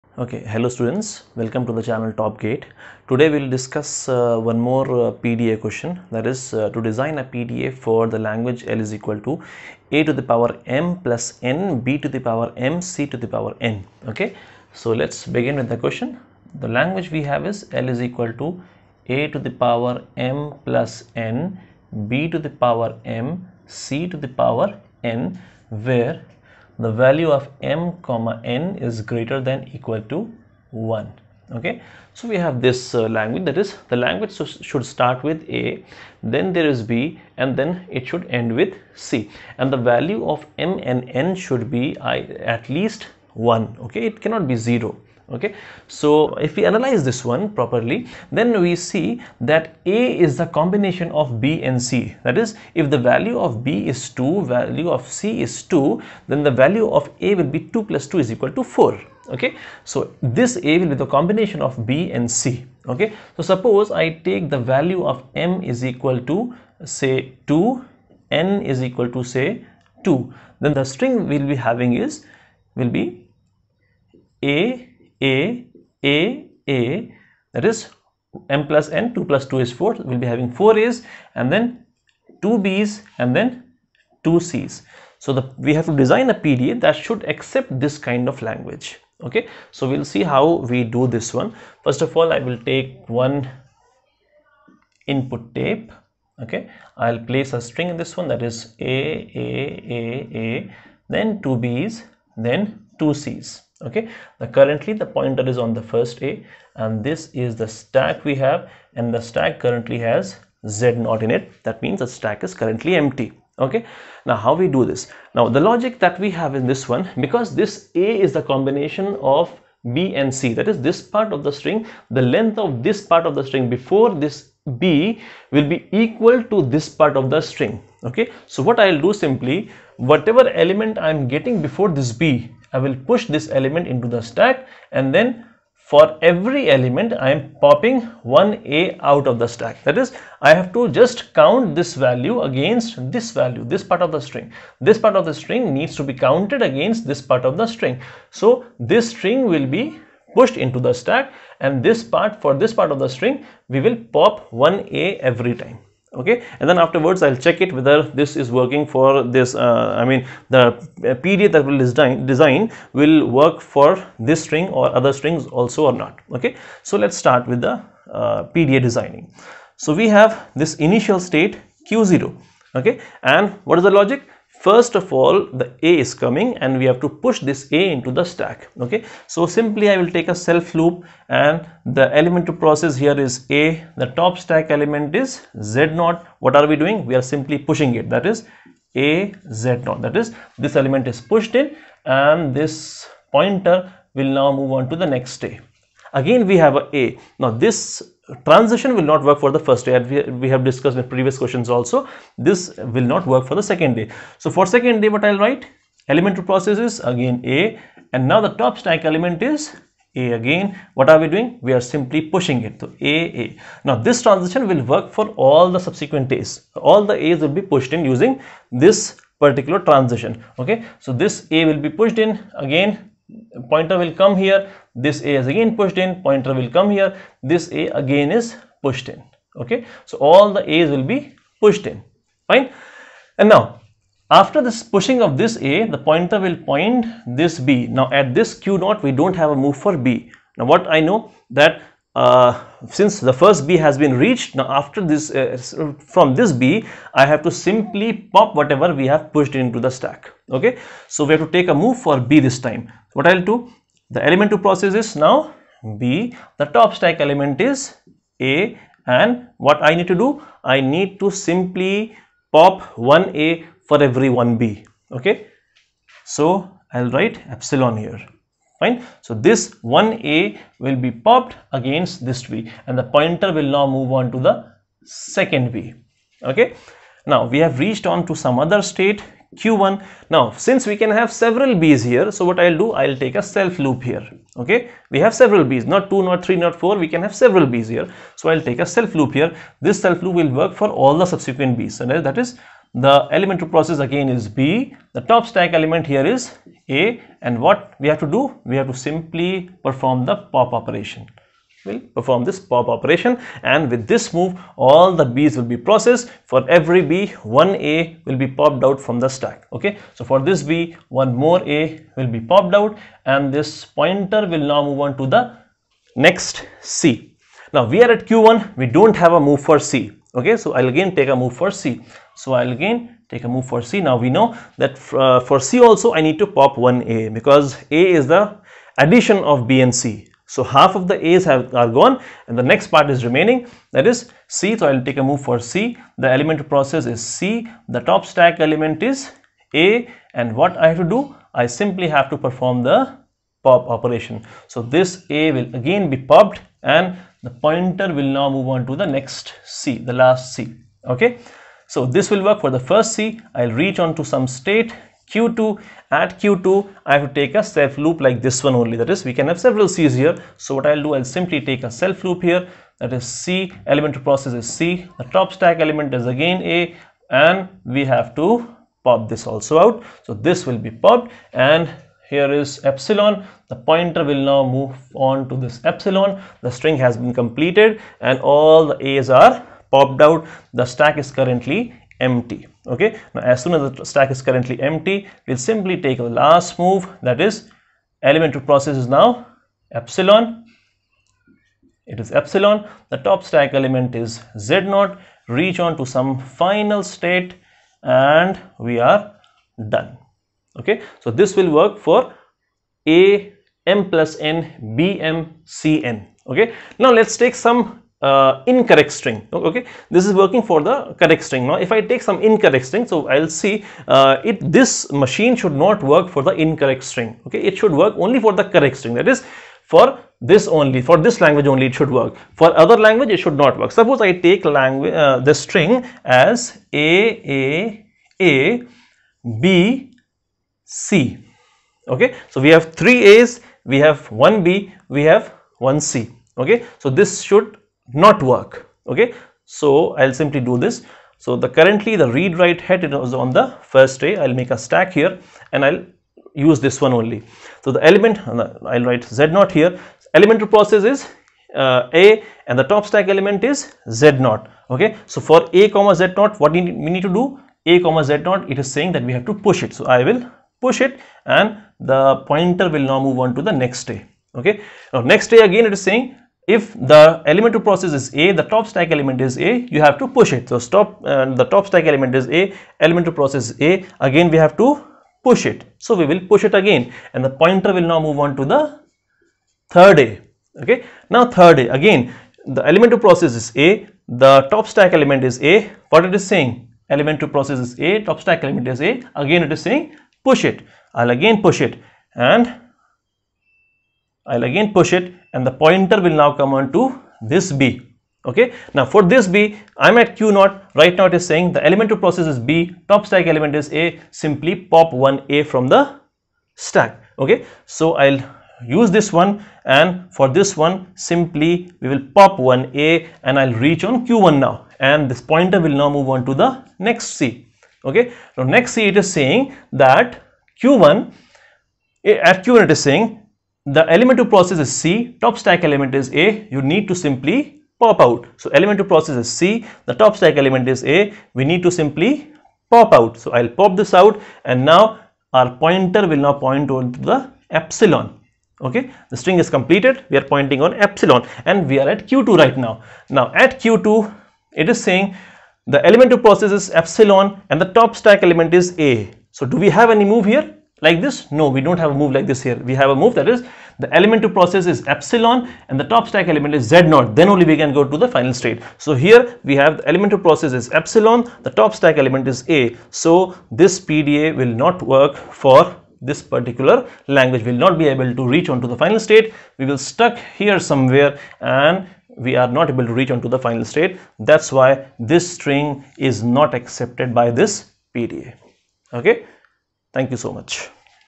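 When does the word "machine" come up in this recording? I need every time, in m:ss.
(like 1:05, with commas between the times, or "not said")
6:55.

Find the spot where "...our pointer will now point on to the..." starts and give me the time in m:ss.
8:55.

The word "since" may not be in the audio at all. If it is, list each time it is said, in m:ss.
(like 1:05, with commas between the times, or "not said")
4:02, 4:40.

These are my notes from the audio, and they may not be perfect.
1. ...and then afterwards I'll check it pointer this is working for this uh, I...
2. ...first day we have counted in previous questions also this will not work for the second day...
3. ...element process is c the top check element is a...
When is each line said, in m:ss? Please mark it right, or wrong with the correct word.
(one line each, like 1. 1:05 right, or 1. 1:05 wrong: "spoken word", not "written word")
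1. 2:36 wrong: "whether", not "pointer"
2. 3:19 wrong: "discussed", not "counted"
3. 5:36 wrong: "stack", not "check".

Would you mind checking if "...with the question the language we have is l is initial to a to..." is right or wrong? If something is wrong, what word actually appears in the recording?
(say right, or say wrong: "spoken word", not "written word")
wrong: "equal", not "initial".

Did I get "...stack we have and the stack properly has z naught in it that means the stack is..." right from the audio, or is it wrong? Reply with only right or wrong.
wrong.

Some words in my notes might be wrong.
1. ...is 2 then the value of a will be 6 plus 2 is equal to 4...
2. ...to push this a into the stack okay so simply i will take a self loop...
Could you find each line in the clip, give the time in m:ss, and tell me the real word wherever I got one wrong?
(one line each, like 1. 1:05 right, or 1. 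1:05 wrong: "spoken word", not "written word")
1. 0:55 wrong: "2", not "6"
2. 2:57 right.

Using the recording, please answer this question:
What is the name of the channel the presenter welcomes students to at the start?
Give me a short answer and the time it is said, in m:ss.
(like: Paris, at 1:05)
Top Gate, at 0:02.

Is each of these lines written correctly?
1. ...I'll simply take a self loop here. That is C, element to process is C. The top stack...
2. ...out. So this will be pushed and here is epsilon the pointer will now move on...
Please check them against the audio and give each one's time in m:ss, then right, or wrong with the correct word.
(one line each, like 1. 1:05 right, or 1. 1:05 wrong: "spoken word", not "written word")
1. 6:01 right
2. 6:09 wrong: "popped", not "pushed".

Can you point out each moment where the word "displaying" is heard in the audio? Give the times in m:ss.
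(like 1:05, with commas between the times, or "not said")
not said.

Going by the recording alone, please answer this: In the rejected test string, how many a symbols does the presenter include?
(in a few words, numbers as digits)
3.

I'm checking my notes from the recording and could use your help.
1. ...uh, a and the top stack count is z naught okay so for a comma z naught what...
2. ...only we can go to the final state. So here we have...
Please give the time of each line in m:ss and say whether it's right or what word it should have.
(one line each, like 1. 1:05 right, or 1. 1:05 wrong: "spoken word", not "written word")
1. 7:31 wrong: "element", not "count"
2. 9:17 right.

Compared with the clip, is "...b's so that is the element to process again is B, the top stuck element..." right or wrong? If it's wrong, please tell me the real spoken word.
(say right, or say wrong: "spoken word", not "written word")
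wrong: "stack", not "stuck".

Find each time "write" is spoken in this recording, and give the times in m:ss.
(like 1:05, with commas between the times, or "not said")
3:25, 4:27, 7:22, 7:29.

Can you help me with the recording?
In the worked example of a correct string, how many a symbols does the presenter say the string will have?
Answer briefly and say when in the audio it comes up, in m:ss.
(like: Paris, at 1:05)
4, at 1:20.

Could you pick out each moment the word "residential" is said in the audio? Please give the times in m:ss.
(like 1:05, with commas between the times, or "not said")
not said.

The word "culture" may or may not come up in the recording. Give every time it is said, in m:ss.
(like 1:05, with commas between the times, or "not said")
not said.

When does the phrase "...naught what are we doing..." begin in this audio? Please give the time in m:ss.
3:06.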